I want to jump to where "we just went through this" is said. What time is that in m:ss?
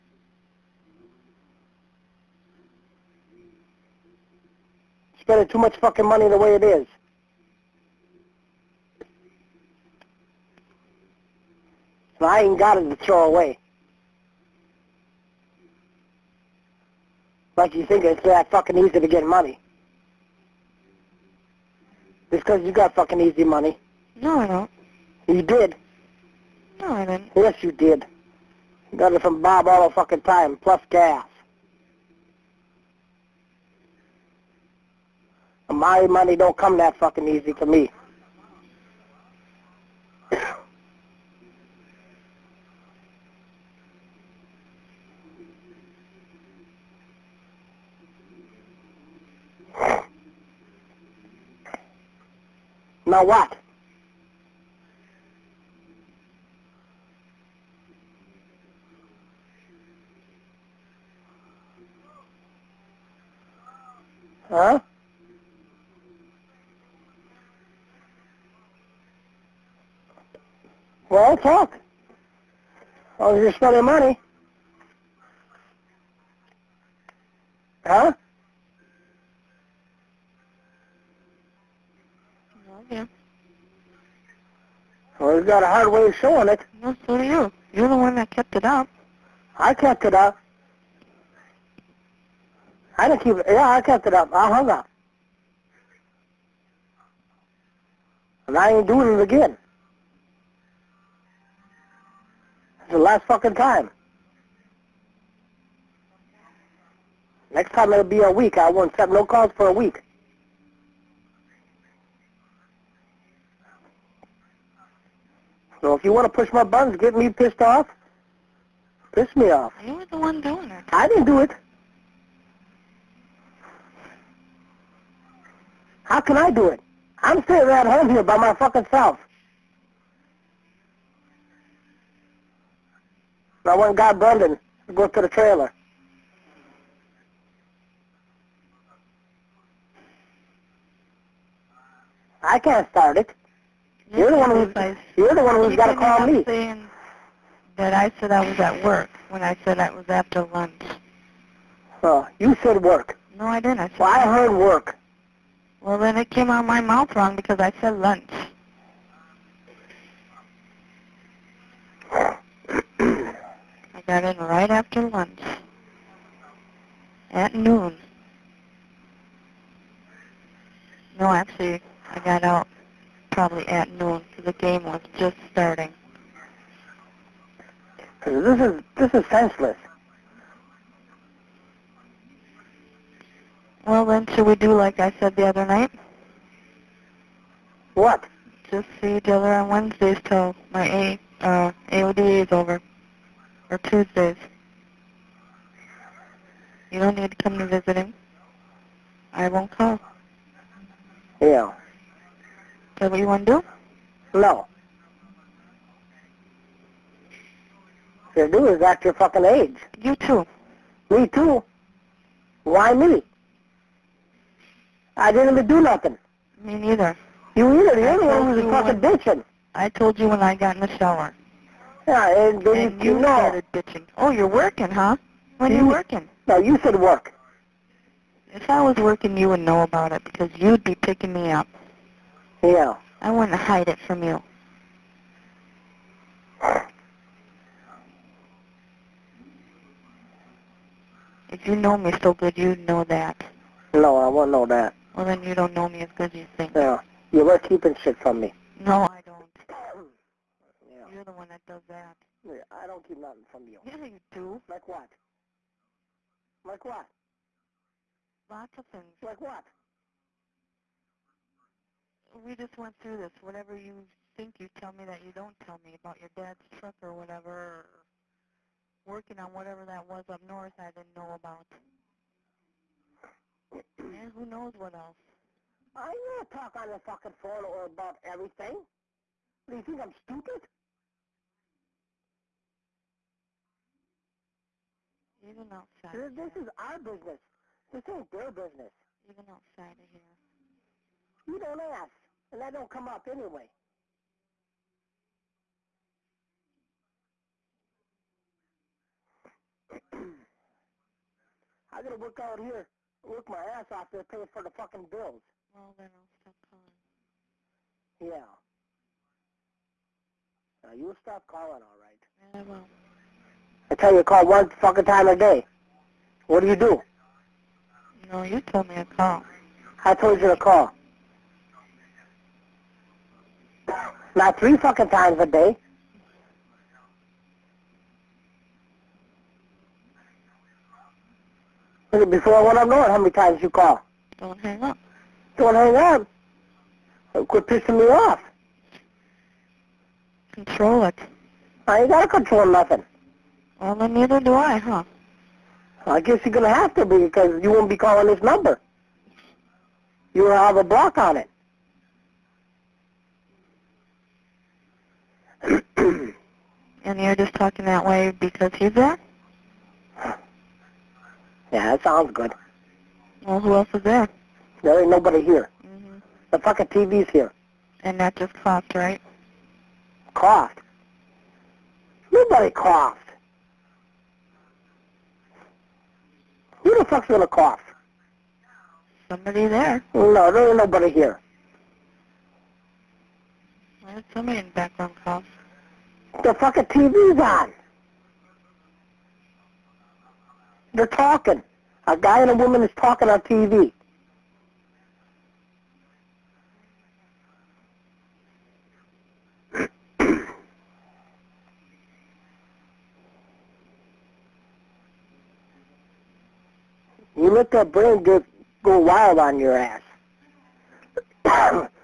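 4:22.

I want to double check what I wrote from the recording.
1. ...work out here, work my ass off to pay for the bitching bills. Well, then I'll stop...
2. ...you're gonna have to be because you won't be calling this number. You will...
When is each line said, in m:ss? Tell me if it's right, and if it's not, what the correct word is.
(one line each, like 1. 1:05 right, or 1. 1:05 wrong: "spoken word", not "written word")
1. 5:02 wrong: "fucking", not "bitching"
2. 5:46 right.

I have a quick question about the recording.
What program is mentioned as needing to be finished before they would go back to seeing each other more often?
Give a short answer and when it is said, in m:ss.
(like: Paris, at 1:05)
AODA, at 3:11.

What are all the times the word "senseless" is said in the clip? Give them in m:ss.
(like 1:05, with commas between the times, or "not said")
2:59.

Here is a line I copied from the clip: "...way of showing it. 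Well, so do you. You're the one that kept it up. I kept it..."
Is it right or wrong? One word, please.
right.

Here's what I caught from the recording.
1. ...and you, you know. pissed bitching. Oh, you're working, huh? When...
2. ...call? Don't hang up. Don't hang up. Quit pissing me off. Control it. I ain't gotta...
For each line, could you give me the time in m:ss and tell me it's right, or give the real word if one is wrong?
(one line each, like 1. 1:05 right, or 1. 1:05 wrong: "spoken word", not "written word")
1. 3:42 wrong: "started", not "pissed"
2. 5:33 right.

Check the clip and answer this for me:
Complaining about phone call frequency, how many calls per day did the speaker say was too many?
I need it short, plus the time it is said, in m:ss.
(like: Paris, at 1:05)
3, at 5:24.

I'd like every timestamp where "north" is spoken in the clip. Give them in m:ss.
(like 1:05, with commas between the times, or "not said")
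4:30, 5:32.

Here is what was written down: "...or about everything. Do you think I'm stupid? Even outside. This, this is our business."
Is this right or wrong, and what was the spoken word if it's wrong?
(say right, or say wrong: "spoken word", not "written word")
right.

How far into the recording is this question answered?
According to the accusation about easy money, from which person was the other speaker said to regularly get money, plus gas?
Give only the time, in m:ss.
0:29.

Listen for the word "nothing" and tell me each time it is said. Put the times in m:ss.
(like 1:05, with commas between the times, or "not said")
3:35, 4:13, 5:42.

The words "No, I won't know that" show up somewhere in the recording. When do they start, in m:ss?
4:03.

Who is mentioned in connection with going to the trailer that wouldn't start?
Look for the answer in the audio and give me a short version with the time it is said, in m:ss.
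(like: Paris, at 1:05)
Brendan, at 2:14.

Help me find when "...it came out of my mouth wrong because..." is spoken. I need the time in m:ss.
2:36.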